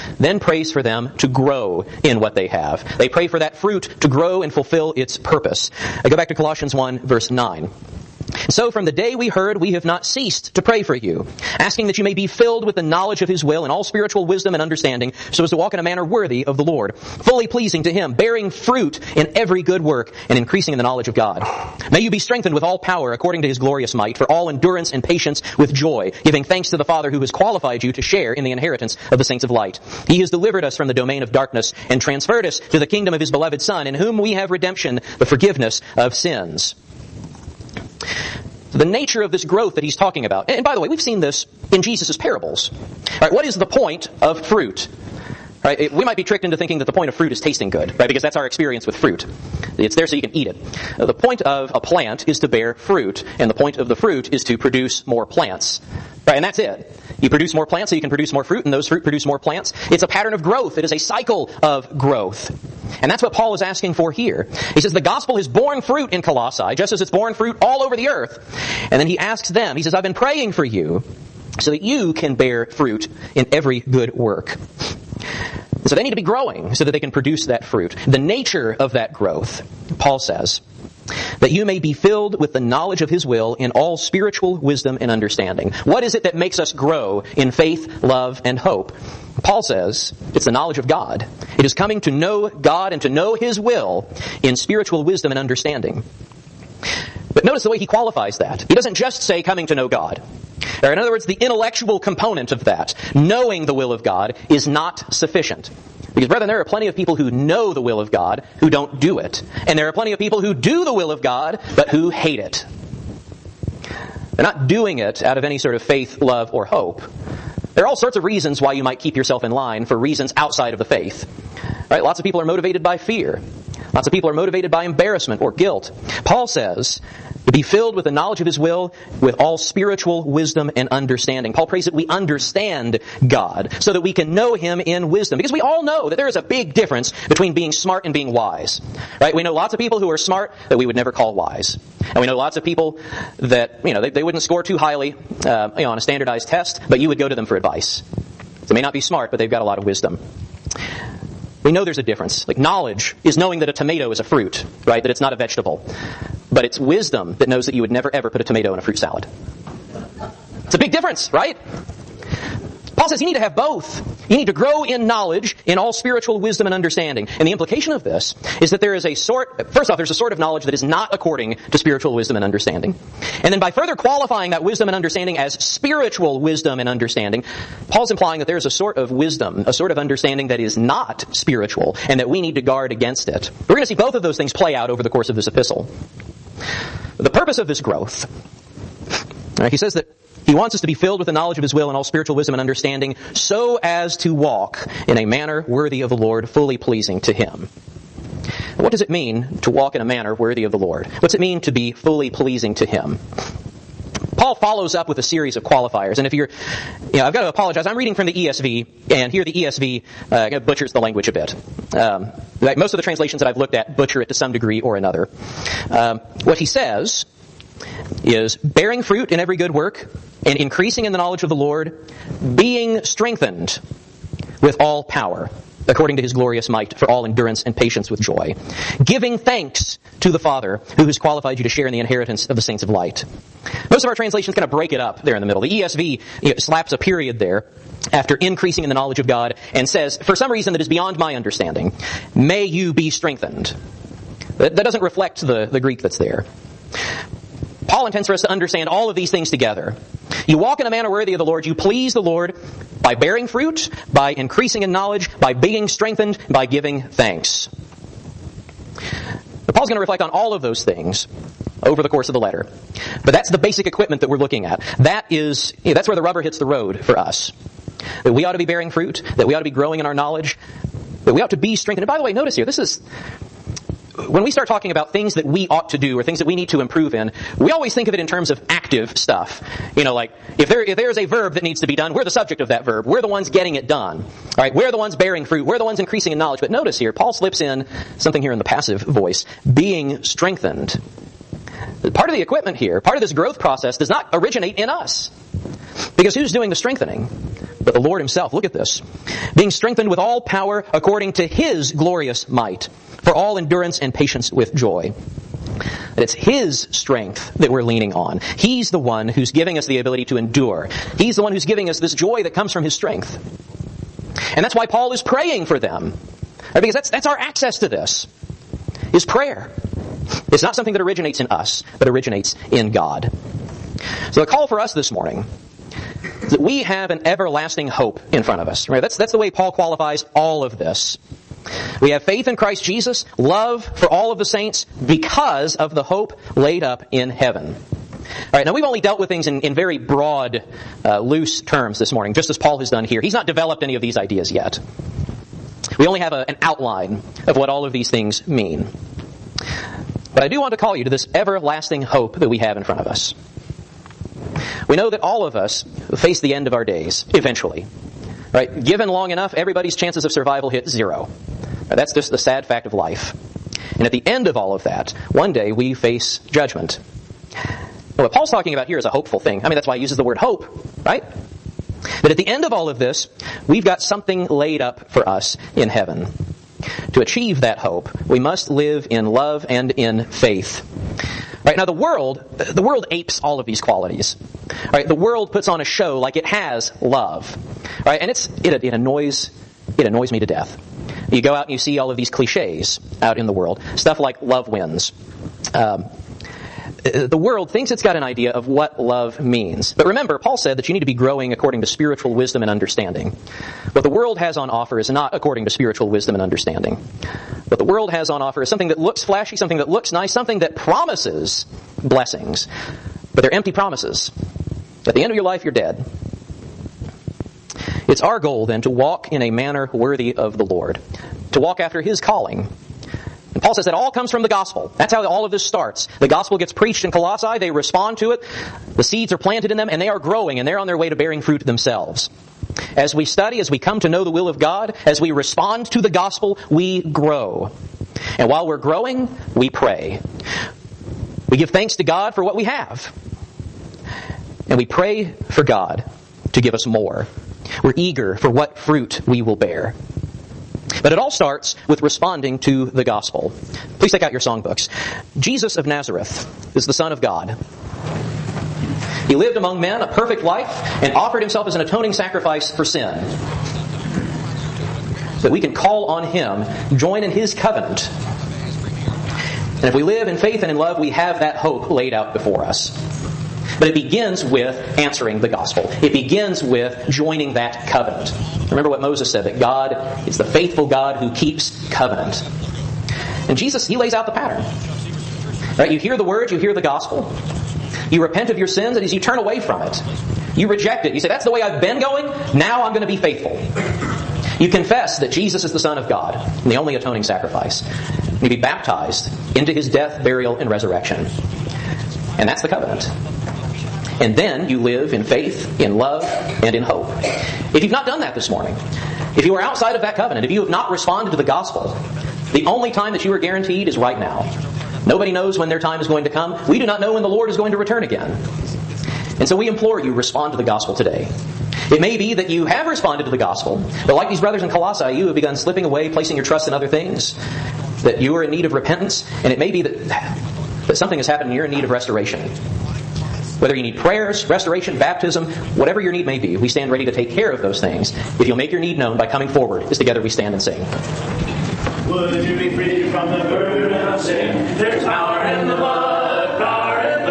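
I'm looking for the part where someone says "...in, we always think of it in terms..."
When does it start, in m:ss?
4:37.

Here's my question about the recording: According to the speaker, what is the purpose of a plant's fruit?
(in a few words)
To produce more plants.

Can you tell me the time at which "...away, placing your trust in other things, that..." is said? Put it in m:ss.
8:45.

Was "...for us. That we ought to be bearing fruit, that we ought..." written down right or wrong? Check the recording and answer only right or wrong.
right.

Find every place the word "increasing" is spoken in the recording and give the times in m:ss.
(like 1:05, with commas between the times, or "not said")
0:20, 3:40, 3:58, 4:14, 4:45.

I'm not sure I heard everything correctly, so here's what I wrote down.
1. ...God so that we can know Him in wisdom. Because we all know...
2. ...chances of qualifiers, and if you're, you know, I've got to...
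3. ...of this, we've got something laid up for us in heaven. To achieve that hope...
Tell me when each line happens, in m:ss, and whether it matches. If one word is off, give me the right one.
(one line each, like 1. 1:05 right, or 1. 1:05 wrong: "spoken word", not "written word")
1. 2:13 right
2. 3:25 wrong: "series", not "chances"
3. 6:12 right.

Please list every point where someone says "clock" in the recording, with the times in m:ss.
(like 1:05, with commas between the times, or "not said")
not said.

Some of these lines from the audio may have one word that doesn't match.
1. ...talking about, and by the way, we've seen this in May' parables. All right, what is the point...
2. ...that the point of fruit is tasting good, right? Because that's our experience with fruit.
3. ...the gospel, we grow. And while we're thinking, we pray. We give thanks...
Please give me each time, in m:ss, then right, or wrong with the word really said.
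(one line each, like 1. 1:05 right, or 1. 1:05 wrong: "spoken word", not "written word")
1. 0:39 wrong: "Jesus", not "May"
2. 0:46 right
3. 7:16 wrong: "growing", not "thinking".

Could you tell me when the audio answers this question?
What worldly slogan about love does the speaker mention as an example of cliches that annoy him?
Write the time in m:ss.
6:34.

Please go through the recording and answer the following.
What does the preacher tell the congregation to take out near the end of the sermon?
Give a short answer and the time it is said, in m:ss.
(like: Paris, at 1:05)
Songbooks, at 7:34.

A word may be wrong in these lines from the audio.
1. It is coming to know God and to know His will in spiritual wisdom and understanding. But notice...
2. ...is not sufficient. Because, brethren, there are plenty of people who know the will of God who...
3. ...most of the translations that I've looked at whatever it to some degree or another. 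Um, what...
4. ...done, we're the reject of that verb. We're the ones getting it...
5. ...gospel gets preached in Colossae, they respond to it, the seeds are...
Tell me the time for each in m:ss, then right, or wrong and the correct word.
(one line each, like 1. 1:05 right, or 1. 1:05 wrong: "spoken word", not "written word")
1. 1:31 right
2. 1:44 right
3. 3:32 wrong: "butcher", not "whatever"
4. 4:41 wrong: "subject", not "reject"
5. 7:06 right.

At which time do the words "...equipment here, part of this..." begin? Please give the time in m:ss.
4:52.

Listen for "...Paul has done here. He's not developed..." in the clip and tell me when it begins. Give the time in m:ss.
5:42.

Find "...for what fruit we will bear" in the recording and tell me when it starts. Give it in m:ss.
7:28.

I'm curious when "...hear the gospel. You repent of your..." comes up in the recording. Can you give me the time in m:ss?
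8:06.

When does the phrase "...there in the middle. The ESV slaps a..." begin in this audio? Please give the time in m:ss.
3:55.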